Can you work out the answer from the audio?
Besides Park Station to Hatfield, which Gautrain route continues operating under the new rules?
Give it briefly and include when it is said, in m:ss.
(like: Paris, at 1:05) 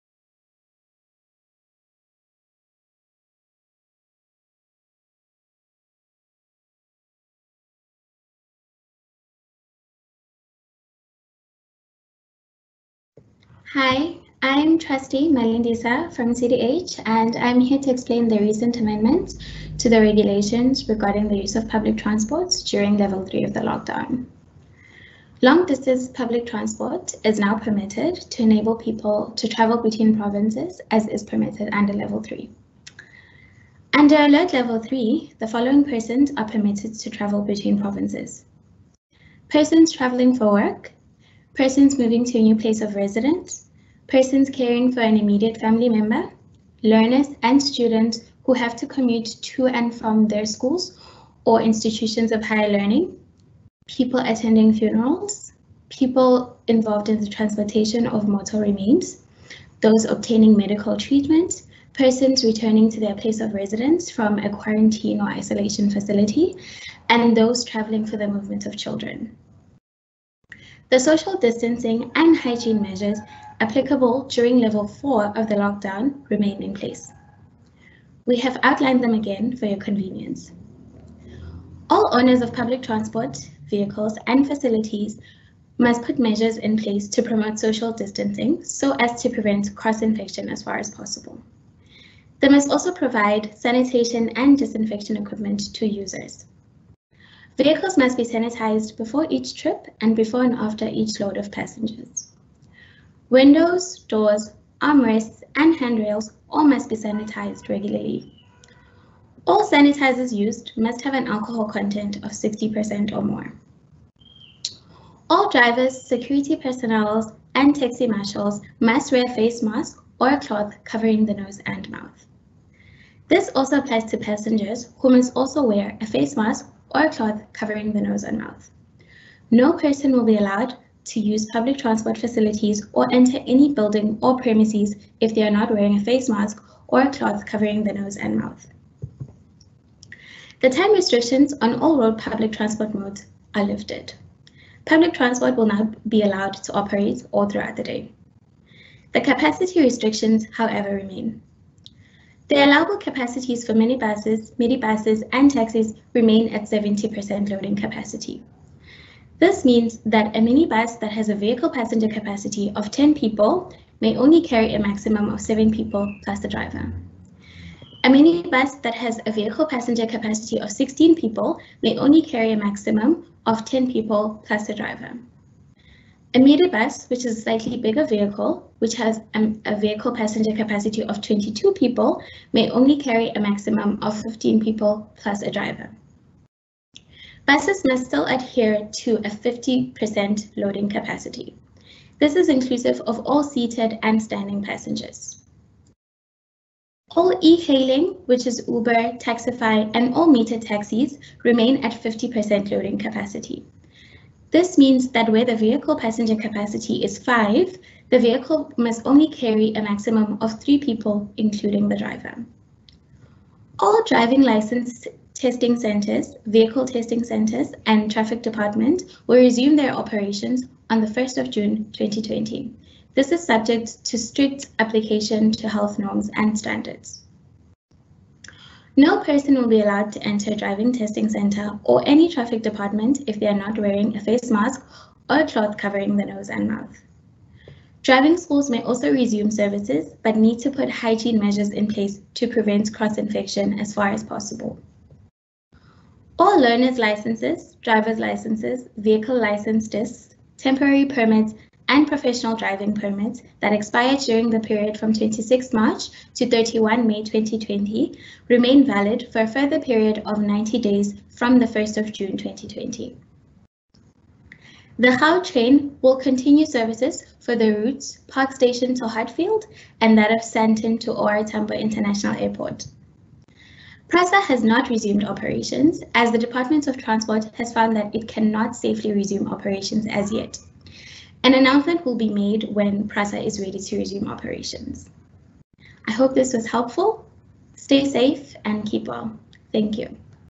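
Sandton to OR International Airport, at 4:30.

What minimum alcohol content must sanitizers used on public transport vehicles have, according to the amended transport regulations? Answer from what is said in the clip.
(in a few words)
60%.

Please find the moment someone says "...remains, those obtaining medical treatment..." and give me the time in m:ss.
0:58.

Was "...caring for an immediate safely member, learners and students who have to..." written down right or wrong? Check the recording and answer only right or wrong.
wrong.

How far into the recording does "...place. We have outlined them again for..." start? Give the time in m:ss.
1:16.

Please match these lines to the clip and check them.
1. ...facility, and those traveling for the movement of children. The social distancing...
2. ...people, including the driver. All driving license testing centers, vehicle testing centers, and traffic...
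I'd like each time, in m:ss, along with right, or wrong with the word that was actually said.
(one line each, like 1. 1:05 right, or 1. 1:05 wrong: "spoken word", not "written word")
1. 1:05 right
2. 3:30 right.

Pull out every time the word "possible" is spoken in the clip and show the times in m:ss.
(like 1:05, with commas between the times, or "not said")
1:30, 4:04.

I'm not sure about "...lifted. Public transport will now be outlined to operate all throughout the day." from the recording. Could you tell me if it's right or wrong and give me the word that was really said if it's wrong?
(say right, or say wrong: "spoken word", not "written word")
wrong: "allowed", not "outlined".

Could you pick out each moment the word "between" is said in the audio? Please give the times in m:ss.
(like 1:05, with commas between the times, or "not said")
0:29, 0:37.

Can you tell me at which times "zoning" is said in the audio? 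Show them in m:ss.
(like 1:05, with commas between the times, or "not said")
not said.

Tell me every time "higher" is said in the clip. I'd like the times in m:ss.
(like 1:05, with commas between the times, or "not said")
0:52.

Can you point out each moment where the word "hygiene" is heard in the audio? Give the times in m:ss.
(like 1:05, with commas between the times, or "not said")
1:12, 4:00.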